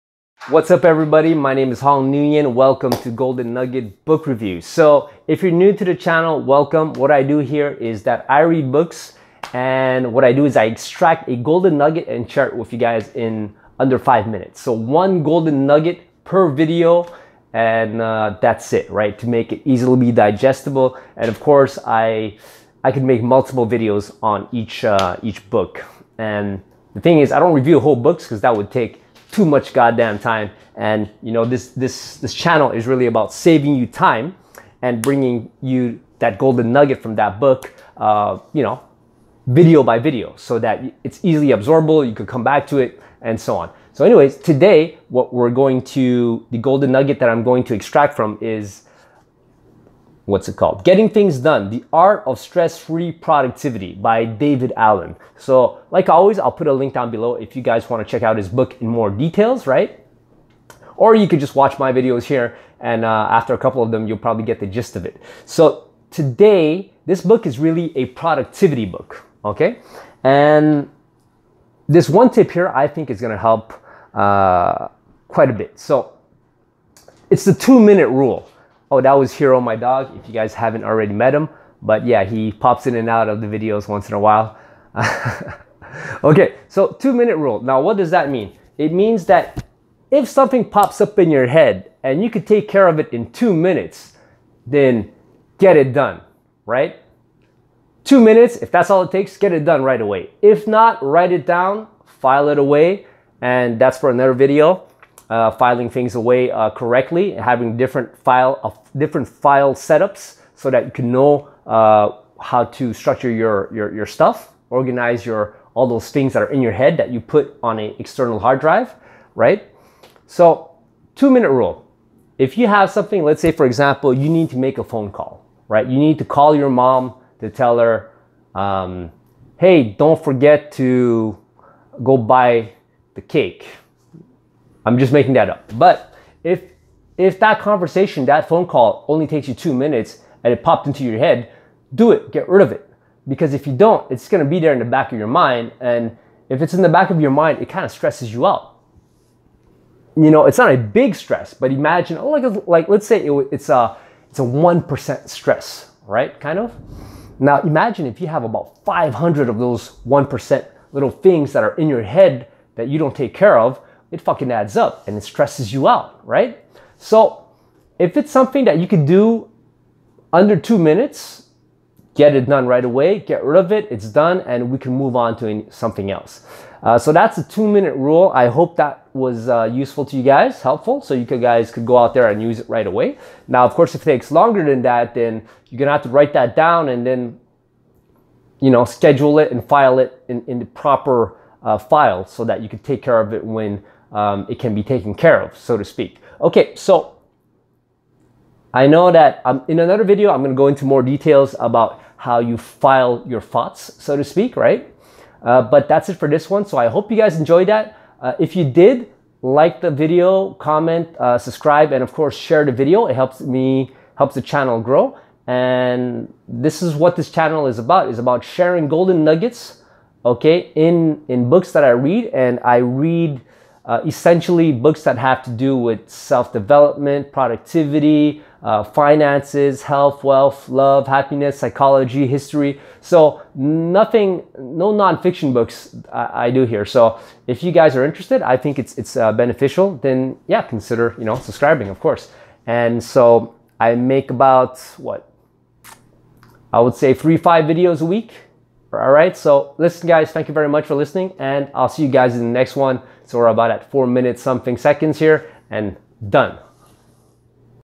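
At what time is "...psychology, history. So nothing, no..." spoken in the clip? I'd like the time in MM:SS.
03:51.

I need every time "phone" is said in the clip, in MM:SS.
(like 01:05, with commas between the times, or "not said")
02:04, 02:18.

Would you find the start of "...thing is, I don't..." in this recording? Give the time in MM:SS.
00:26.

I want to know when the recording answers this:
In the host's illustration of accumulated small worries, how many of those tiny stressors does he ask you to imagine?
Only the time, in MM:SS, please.
02:38.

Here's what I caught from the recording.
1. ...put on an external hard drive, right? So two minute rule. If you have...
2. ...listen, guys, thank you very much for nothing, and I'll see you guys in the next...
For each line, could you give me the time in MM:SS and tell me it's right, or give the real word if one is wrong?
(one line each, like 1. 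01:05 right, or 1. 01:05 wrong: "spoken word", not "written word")
1. 01:57 right
2. 04:09 wrong: "listening", not "nothing".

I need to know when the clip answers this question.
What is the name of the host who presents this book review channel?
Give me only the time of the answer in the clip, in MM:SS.
00:01.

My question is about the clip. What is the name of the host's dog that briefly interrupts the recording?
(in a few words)
Hero.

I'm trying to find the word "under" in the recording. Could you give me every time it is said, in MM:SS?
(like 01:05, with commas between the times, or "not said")
00:13, 02:50.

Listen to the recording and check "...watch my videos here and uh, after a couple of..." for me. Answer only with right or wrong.
right.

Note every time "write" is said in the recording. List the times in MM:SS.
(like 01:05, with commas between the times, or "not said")
01:41, 03:06.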